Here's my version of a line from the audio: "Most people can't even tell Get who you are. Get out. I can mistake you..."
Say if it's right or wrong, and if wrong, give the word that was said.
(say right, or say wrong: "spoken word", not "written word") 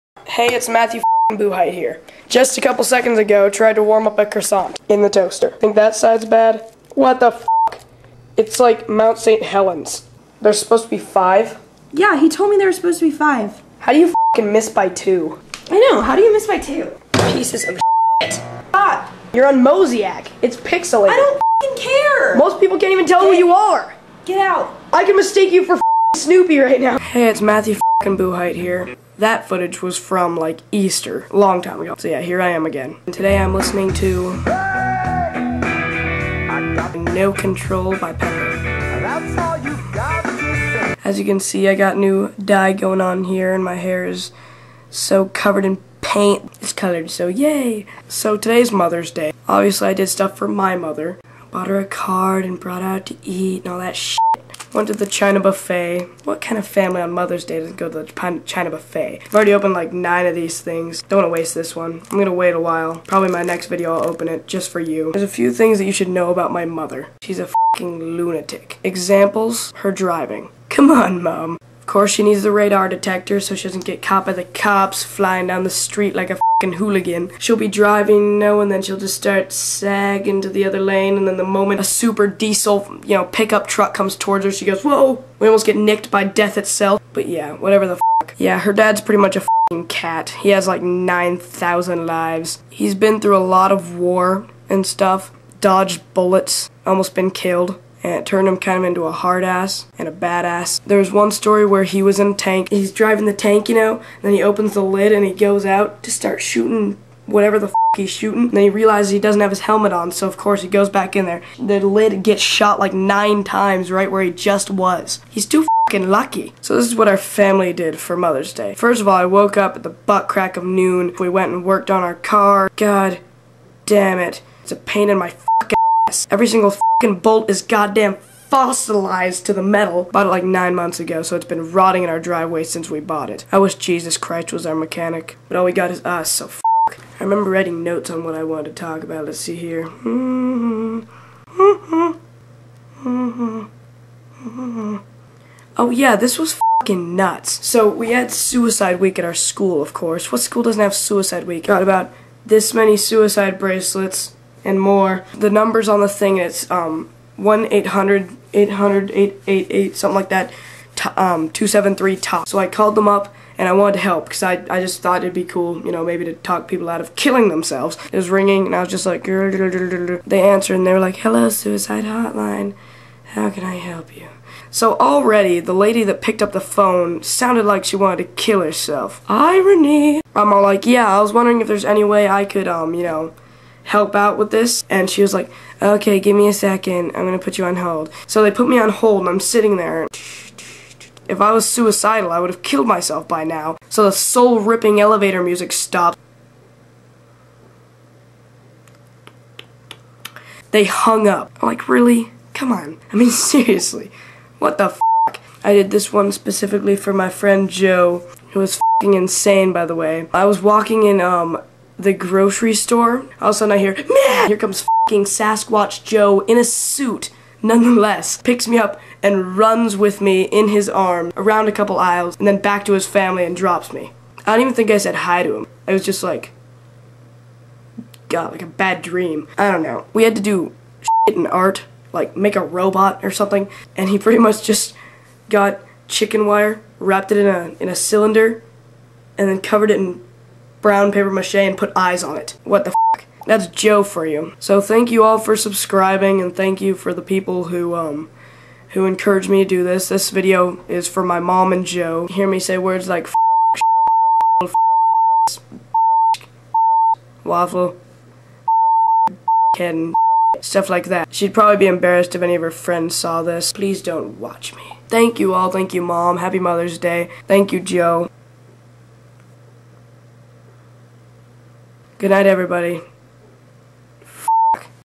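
right.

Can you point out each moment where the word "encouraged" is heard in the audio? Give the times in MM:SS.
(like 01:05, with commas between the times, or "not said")
04:09.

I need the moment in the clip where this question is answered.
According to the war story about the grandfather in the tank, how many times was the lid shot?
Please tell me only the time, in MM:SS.
01:52.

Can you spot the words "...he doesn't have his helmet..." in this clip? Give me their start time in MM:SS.
01:49.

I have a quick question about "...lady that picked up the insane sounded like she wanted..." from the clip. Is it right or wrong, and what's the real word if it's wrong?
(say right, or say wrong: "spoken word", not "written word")
wrong: "phone", not "insane".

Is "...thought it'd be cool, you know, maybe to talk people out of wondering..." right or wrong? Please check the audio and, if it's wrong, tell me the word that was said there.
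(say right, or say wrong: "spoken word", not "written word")
wrong: "killing", not "wondering".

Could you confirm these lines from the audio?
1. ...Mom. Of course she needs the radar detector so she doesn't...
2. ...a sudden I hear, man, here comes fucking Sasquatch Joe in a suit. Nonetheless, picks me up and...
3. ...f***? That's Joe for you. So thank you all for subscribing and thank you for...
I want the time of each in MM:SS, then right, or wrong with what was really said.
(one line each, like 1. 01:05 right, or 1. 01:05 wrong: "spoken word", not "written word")
1. 01:11 right
2. 03:33 right
3. 04:03 right.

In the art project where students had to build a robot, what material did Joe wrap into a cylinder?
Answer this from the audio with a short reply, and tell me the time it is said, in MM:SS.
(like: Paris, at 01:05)
Chicken wire, at 03:56.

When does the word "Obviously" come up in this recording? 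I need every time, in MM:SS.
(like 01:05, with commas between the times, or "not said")
00:49.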